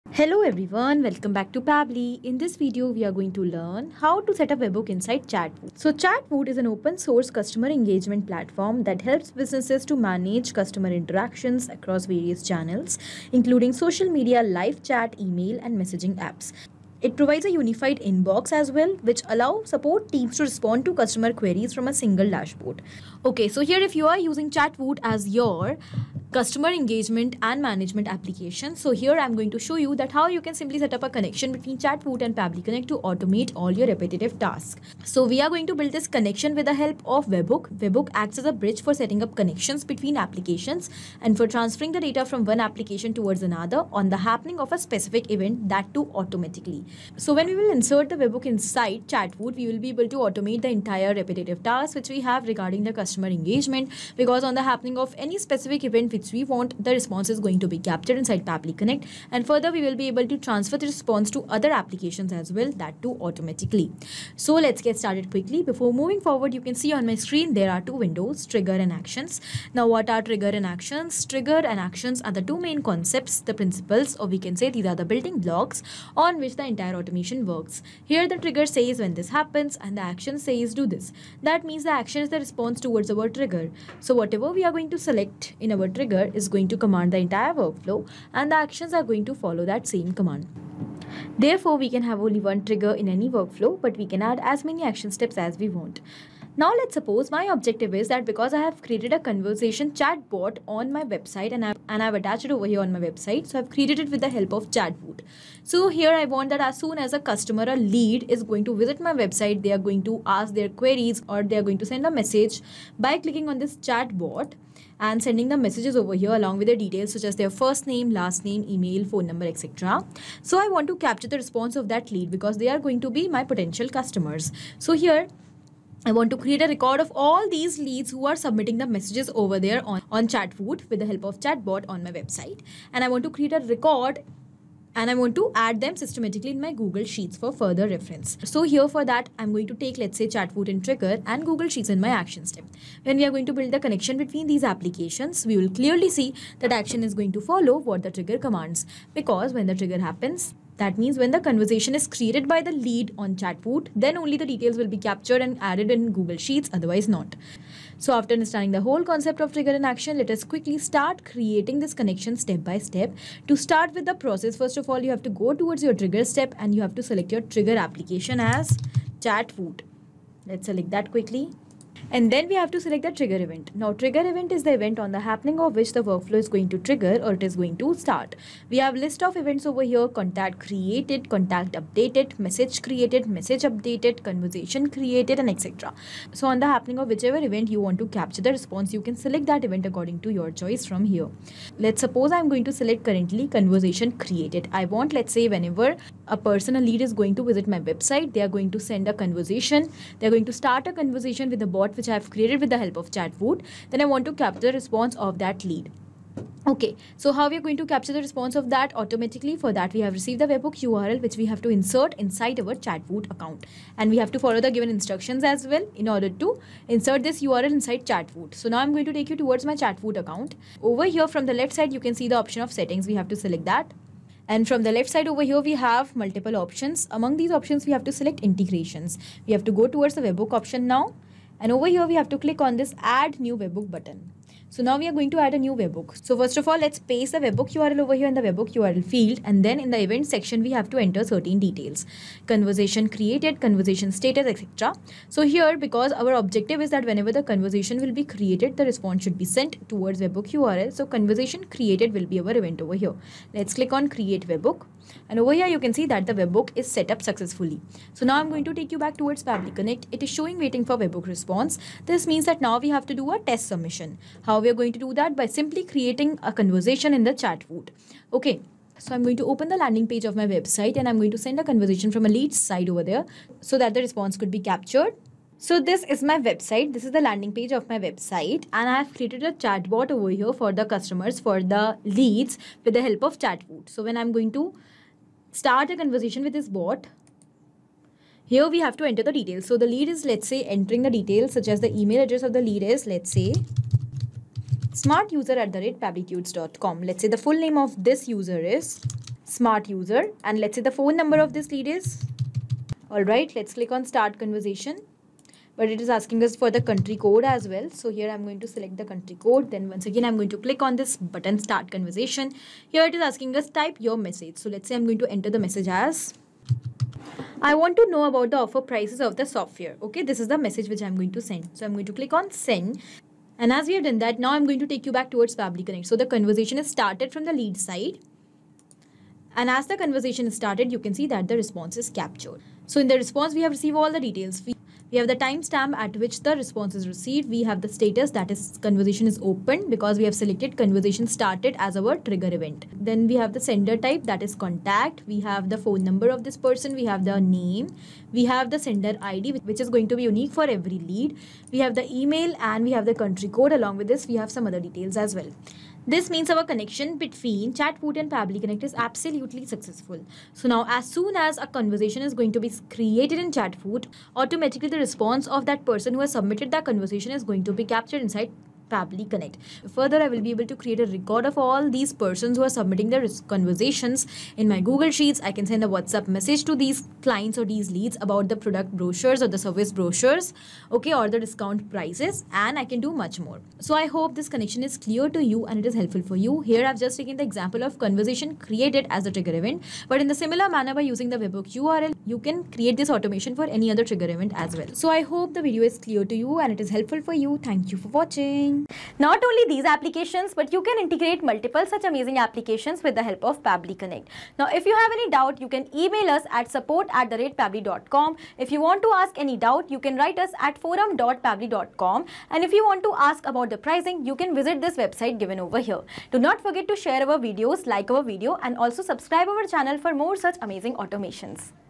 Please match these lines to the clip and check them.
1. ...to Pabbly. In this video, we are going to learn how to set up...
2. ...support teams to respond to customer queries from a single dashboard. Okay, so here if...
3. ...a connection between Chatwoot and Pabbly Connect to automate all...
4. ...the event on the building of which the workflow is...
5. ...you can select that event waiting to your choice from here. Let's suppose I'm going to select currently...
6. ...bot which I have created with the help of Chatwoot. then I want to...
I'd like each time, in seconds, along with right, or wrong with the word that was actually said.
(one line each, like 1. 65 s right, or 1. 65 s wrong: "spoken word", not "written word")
1. 1 s right
2. 19 s right
3. 31 s right
4. 174 s wrong: "happening", not "building"
5. 188 s wrong: "according", not "waiting"
6. 201 s right.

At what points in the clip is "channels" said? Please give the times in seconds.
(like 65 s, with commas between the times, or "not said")
12 s, 419 s.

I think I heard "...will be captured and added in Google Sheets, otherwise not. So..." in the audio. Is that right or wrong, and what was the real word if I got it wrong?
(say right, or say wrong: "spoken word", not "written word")
right.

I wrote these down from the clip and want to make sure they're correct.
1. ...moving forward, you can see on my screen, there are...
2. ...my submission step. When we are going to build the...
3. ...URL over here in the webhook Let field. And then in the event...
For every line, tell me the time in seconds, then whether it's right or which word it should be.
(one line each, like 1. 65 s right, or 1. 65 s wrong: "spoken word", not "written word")
1. 65 s right
2. 142 s wrong: "action", not "submission"
3. 237 s wrong: "URL", not "Let".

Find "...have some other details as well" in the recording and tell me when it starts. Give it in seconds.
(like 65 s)
354 s.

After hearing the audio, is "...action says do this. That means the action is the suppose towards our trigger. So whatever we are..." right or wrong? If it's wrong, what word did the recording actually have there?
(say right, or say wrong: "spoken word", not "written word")
wrong: "response", not "suppose".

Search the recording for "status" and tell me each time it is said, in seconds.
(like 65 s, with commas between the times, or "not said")
244 s, 337 s.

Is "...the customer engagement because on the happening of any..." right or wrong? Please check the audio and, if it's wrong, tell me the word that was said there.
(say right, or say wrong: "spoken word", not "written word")
right.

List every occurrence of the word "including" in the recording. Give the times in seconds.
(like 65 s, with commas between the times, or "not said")
13 s.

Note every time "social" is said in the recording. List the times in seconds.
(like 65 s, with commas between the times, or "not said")
13 s.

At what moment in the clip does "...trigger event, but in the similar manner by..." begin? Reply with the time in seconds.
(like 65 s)
389 s.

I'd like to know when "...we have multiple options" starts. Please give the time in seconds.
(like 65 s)
225 s.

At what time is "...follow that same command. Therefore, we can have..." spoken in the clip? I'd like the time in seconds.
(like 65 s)
89 s.